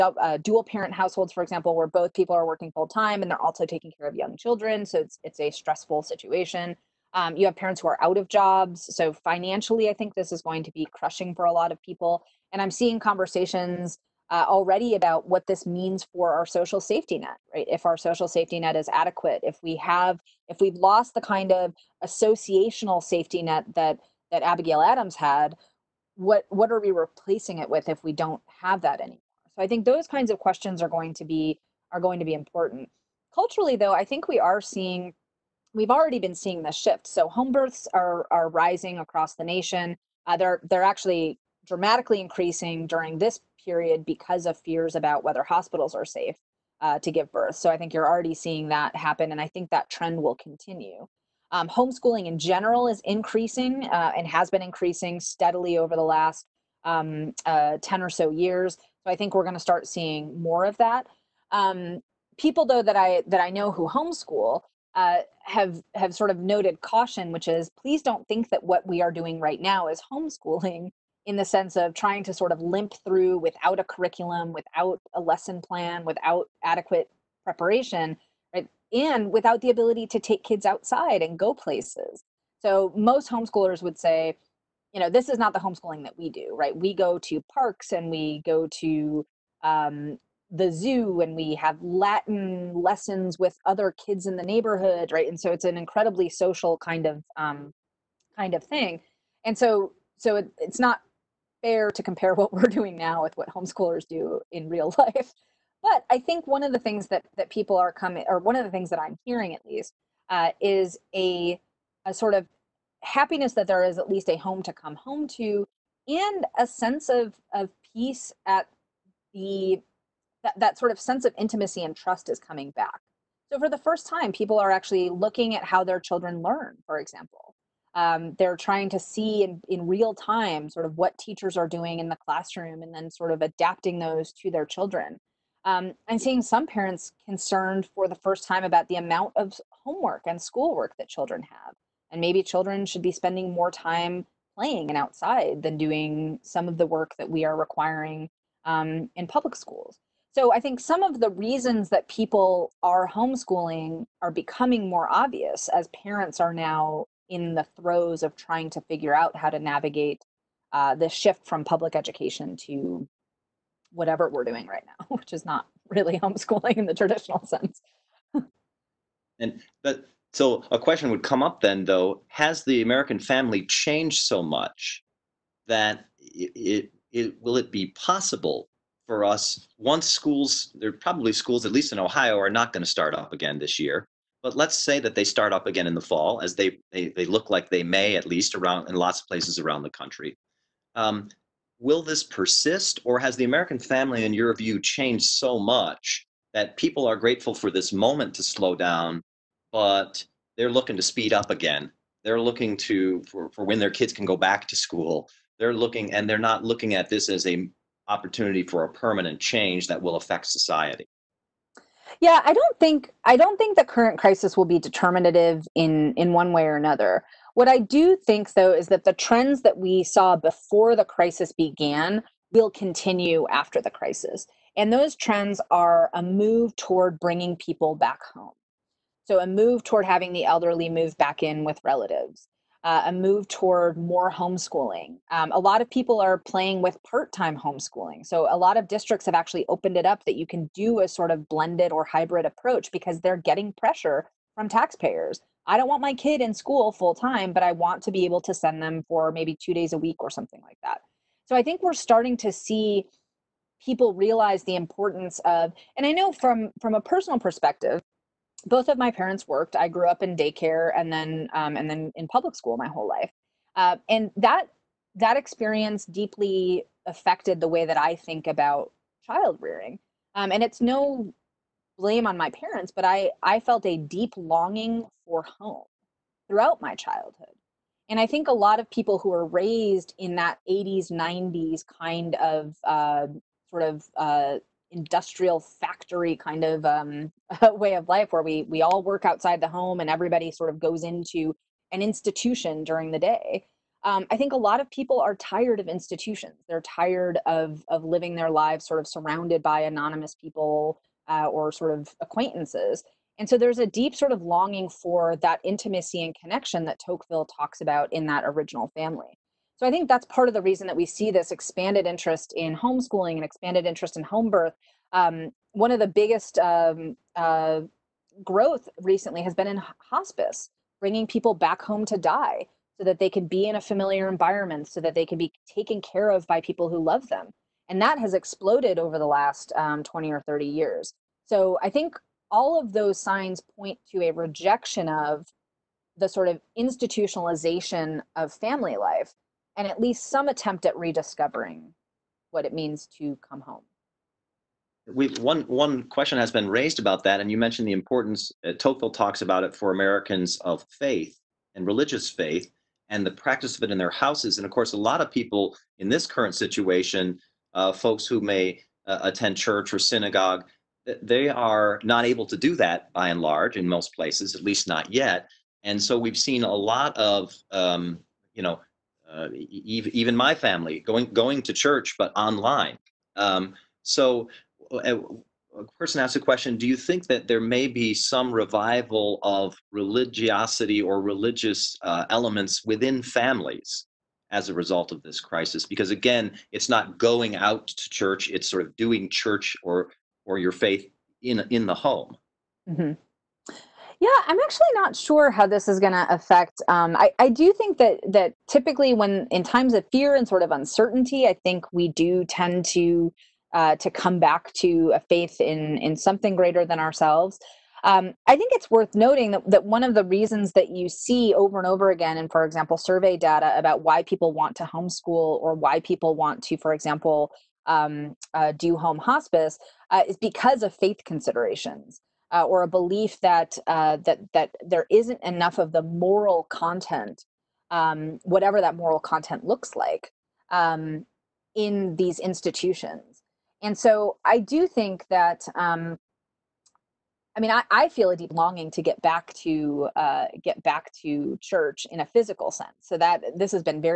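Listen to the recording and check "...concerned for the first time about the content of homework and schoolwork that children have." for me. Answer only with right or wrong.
wrong.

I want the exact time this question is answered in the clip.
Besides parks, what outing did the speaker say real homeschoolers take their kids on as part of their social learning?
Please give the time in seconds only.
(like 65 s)
90 s.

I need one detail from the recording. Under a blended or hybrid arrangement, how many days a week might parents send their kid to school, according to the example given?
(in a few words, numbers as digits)
2.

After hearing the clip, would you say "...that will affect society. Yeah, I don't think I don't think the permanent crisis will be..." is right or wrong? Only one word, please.
wrong.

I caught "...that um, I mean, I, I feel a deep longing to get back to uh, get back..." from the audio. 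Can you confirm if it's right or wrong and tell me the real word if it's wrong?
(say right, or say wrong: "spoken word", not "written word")
right.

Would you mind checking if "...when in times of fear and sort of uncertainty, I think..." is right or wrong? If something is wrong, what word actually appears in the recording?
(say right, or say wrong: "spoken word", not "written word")
right.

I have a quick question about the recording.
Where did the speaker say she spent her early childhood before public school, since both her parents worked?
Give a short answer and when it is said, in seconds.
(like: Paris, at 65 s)
daycare, at 260 s.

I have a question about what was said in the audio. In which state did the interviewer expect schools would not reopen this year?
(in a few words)
Ohio.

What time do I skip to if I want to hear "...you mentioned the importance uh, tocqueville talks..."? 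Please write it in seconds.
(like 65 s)
347 s.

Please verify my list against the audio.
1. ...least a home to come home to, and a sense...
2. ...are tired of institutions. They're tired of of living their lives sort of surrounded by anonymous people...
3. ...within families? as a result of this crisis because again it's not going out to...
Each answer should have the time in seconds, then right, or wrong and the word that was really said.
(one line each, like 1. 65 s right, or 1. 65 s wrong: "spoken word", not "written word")
1. 114 s right
2. 295 s right
3. 382 s right.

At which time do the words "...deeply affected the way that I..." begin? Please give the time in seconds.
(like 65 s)
266 s.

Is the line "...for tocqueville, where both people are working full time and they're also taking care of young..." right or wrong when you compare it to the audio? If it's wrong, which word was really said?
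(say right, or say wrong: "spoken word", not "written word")
wrong: "example", not "tocqueville".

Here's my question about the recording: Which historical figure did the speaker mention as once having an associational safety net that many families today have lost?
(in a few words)
Abigail Adams.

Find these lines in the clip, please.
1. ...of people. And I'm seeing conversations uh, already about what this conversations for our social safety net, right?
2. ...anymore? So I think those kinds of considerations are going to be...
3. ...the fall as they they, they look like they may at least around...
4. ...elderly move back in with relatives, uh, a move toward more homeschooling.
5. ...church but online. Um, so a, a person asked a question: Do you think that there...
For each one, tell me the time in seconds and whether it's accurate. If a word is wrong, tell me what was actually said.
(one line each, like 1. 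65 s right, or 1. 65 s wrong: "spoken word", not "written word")
1. 11 s wrong: "means", not "conversations"
2. 28 s wrong: "questions", not "considerations"
3. 185 s right
4. 230 s right
5. 371 s right.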